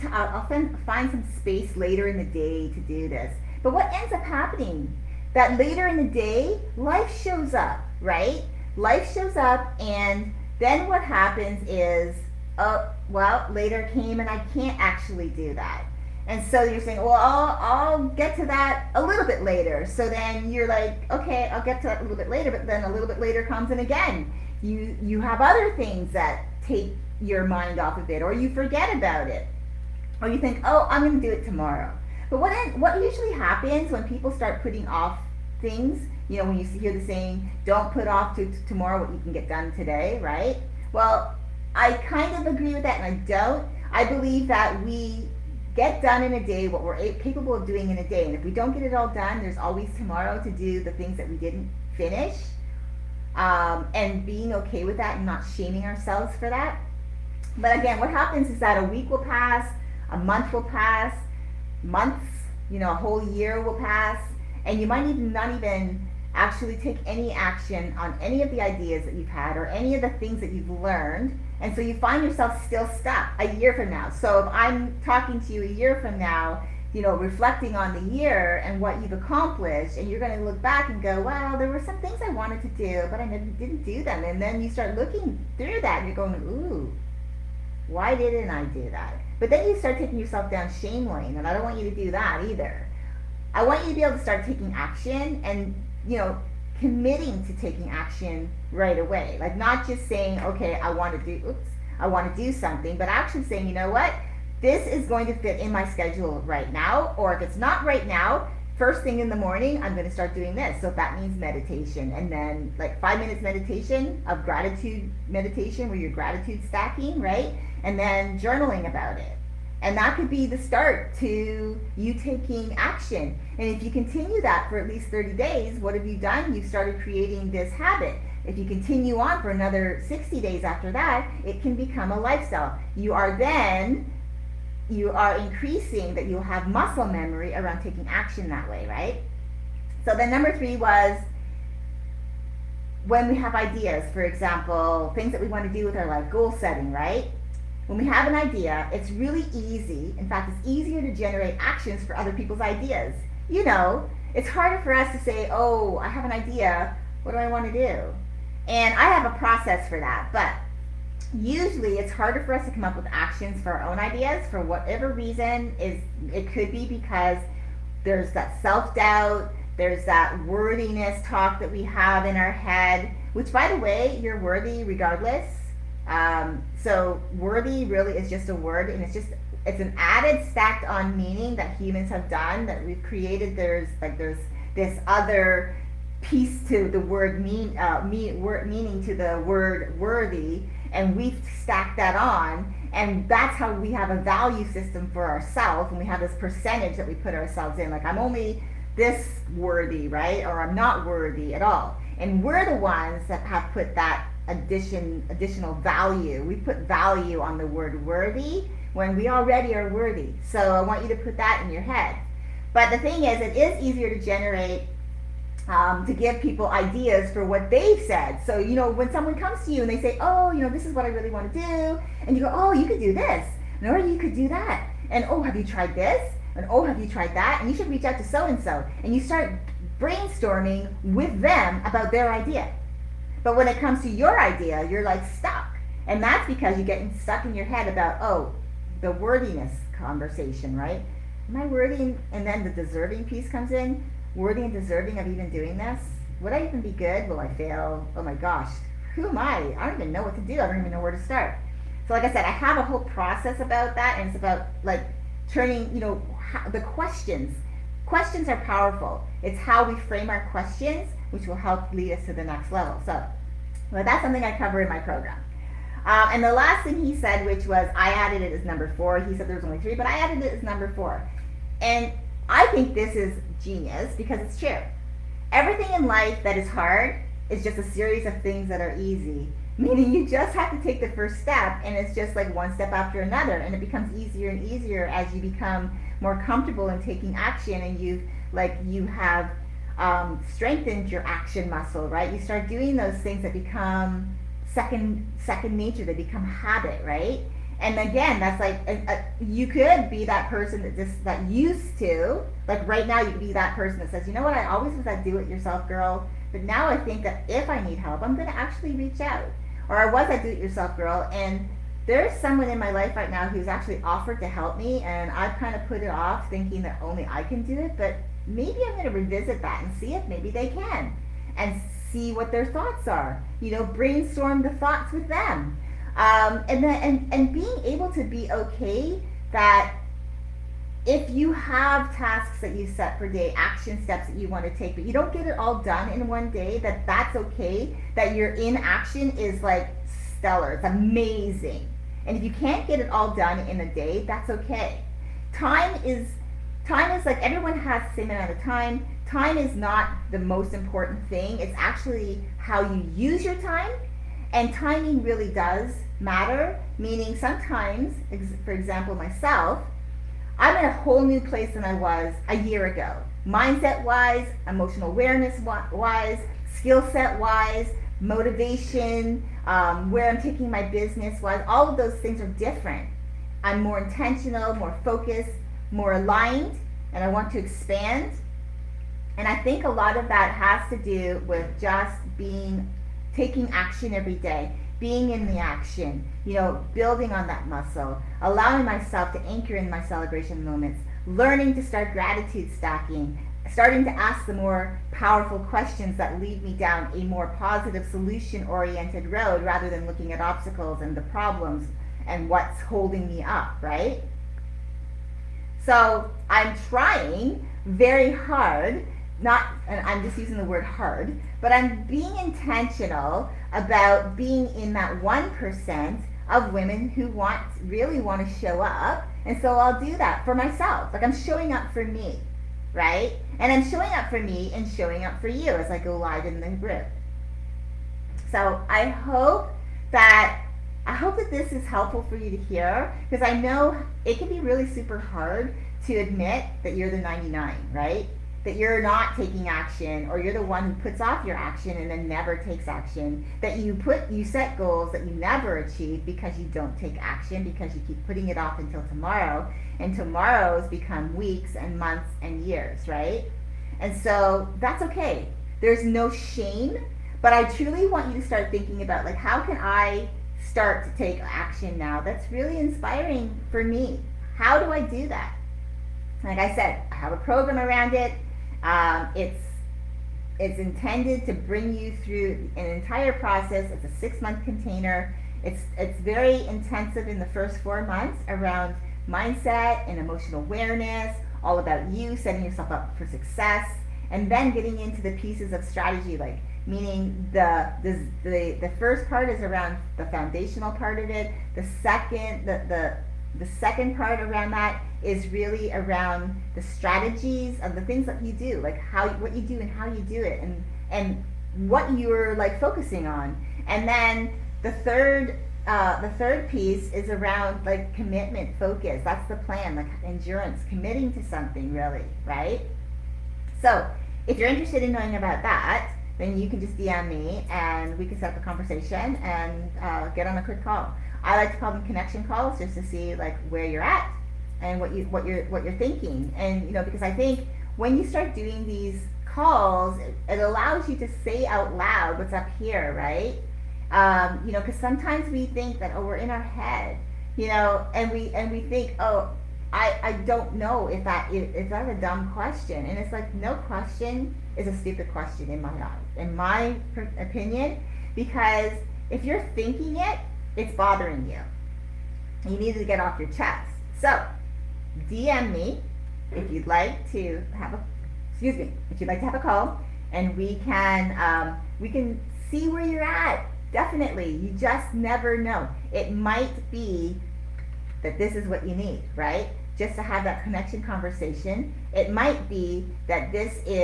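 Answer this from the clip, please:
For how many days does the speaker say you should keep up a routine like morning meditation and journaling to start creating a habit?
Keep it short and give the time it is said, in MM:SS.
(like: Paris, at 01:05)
30, at 02:05.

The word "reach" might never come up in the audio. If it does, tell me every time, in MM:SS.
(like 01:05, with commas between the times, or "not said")
03:47, 05:08.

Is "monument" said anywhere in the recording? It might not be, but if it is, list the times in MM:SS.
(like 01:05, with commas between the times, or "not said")
not said.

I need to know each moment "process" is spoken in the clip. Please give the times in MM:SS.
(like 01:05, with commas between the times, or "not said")
02:39, 04:13, 07:53.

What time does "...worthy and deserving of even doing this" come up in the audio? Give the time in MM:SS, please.
04:04.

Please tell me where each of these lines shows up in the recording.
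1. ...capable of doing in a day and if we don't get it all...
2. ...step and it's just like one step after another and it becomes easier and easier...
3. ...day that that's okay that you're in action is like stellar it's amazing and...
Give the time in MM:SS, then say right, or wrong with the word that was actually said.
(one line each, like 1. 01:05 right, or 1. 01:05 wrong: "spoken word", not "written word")
1. 00:47 right
2. 04:41 right
3. 05:36 right.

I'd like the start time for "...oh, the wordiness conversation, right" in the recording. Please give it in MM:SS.
03:58.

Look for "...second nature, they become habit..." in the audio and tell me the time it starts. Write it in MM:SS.
04:55.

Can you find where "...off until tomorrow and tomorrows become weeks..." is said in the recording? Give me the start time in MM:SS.
07:28.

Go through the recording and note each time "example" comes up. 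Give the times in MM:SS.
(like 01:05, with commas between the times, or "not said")
02:24, 05:58.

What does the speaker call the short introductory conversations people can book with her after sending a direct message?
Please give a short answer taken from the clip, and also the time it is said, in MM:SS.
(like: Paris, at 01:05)
connection calls, at 08:42.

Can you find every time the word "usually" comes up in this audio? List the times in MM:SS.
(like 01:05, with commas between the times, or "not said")
00:33, 02:41.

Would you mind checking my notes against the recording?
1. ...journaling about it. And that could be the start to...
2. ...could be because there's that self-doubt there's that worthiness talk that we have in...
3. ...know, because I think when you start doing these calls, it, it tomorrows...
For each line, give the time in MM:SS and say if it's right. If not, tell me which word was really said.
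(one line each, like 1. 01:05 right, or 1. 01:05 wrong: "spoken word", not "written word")
1. 01:58 right
2. 02:46 right
3. 08:46 wrong: "allows", not "tomorrows".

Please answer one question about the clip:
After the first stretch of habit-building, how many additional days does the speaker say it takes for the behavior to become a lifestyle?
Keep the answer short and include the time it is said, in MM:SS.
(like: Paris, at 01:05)
60, at 02:10.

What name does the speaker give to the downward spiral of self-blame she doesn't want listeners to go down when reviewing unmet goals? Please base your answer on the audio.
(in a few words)
shame lane.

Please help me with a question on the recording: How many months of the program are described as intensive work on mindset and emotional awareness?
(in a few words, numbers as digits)
4.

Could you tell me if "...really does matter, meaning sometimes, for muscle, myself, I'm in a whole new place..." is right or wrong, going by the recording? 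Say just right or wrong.
wrong.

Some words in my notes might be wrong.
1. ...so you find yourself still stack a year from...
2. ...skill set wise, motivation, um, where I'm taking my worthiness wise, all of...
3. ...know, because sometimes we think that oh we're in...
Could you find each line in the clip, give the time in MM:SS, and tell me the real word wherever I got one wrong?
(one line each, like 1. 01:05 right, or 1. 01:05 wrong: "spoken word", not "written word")
1. 01:11 wrong: "stuck", not "stack"
2. 06:06 wrong: "business", not "worthiness"
3. 08:54 right.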